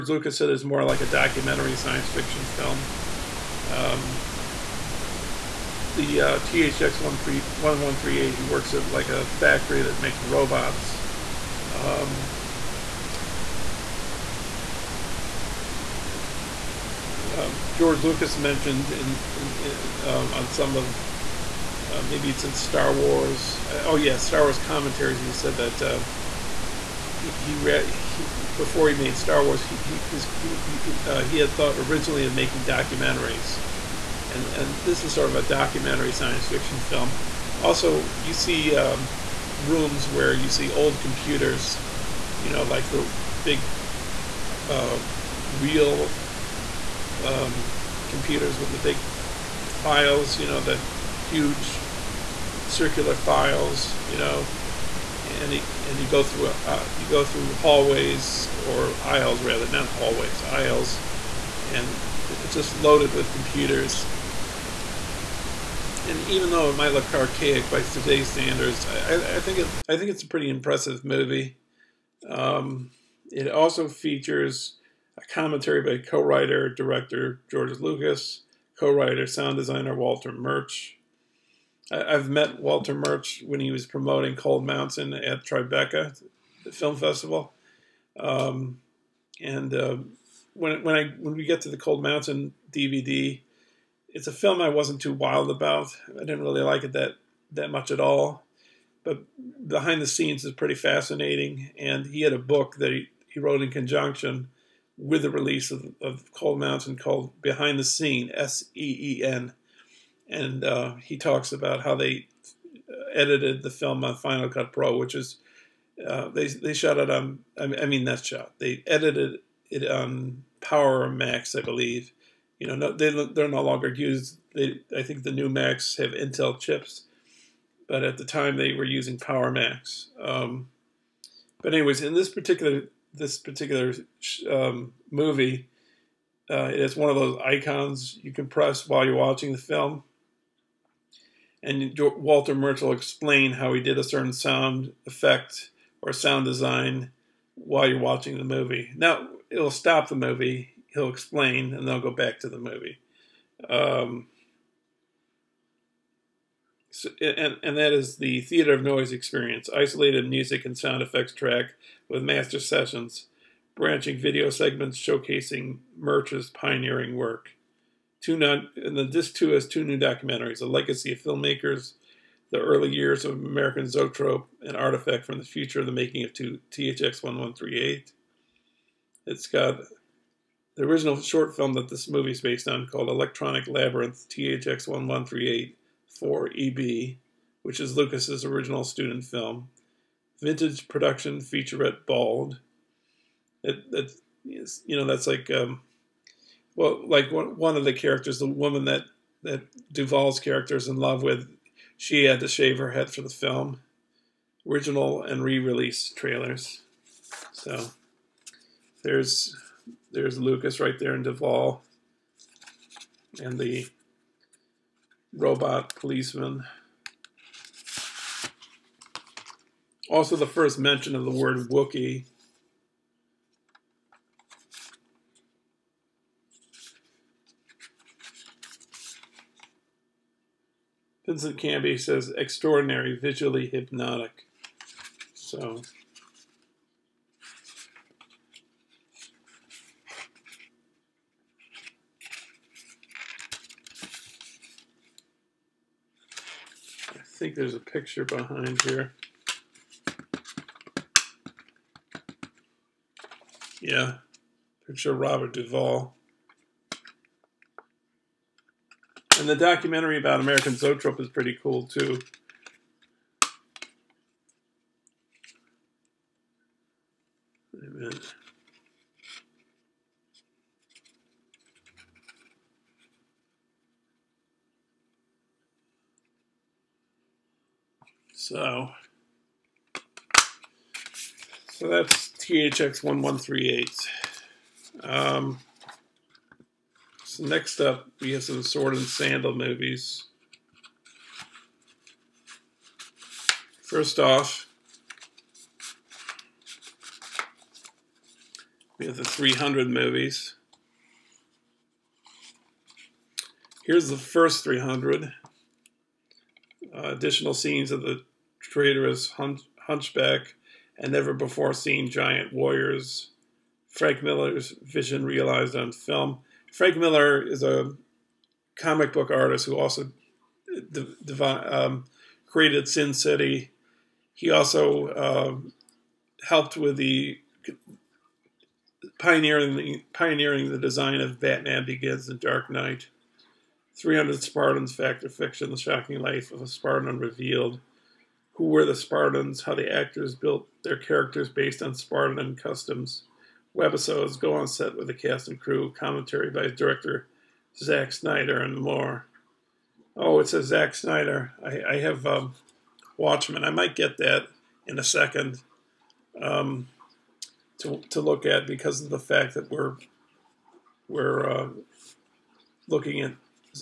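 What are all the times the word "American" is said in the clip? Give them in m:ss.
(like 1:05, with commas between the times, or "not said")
2:53, 4:20.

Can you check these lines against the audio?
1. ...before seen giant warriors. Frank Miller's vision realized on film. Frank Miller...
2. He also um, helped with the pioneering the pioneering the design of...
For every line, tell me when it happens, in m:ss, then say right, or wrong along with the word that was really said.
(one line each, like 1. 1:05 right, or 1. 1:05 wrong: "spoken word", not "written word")
1. 5:11 right
2. 5:24 right.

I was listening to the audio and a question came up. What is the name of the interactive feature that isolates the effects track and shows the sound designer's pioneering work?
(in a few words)
Theater of Noise.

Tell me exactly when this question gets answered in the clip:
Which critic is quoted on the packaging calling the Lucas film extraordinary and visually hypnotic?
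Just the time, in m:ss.
3:51.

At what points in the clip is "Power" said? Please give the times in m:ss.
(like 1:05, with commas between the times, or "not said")
2:00, 2:09.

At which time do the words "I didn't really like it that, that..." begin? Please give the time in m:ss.
1:36.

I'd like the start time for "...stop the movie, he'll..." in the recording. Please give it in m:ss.
2:29.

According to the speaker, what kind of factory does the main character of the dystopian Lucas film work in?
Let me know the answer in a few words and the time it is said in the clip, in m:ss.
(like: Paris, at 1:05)
A factory that makes robots, at 0:09.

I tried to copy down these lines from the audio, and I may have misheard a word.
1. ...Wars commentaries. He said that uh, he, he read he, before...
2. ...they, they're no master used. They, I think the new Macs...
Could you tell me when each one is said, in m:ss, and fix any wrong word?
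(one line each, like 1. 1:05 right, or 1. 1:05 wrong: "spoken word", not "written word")
1. 0:24 right
2. 2:02 wrong: "longer", not "master".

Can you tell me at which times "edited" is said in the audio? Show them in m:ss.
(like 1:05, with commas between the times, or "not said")
1:53, 1:58.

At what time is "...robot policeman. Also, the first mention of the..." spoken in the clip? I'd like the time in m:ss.
3:35.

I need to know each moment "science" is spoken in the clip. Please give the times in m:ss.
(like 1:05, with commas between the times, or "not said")
0:01, 0:36.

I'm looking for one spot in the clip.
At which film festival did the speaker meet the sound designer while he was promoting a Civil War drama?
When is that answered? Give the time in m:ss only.
1:25.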